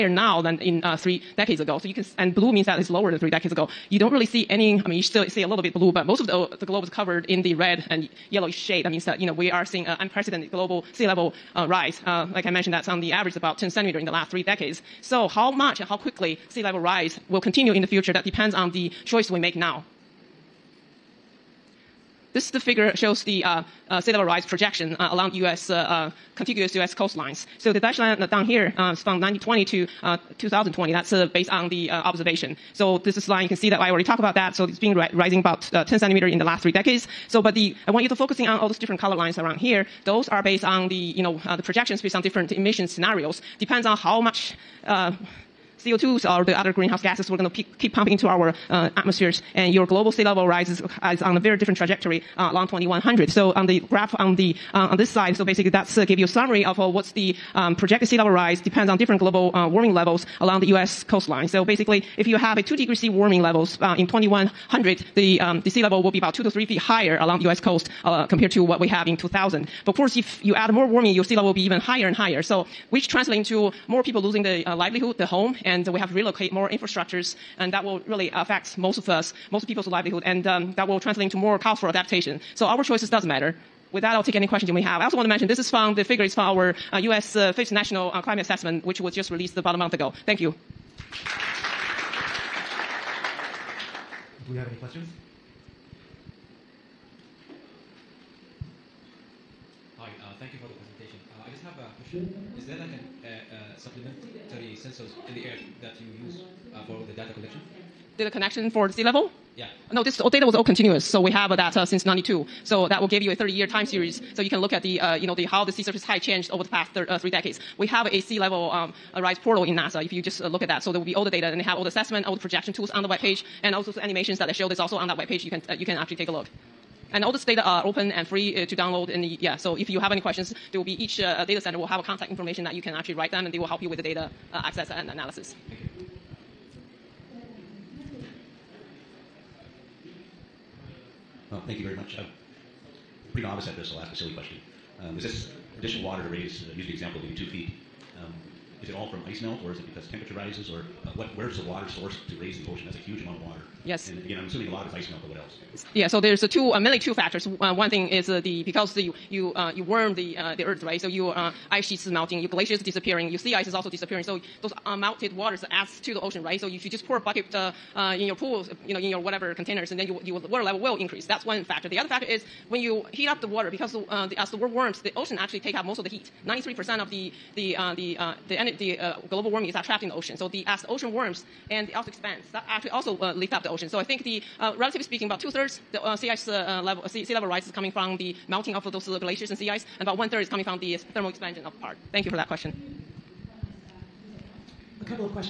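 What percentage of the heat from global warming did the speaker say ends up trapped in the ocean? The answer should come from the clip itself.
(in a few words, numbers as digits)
93%.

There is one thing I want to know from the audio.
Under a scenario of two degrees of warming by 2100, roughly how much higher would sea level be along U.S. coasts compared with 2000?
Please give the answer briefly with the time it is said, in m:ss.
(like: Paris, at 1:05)
2 to 3 feet, at 1:06.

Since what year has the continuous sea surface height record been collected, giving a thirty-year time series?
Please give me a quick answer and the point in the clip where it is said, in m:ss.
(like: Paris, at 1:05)
1992, at 1:52.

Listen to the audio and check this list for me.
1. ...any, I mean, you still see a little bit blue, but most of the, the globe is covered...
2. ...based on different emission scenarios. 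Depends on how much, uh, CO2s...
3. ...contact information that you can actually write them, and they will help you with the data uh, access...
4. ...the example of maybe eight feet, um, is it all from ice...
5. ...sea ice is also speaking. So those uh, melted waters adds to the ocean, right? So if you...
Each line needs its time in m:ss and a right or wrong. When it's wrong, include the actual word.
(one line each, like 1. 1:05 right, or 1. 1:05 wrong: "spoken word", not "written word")
1. 0:04 right
2. 0:41 right
3. 2:12 right
4. 2:26 wrong: "two", not "eight"
5. 2:43 wrong: "disappearing", not "speaking".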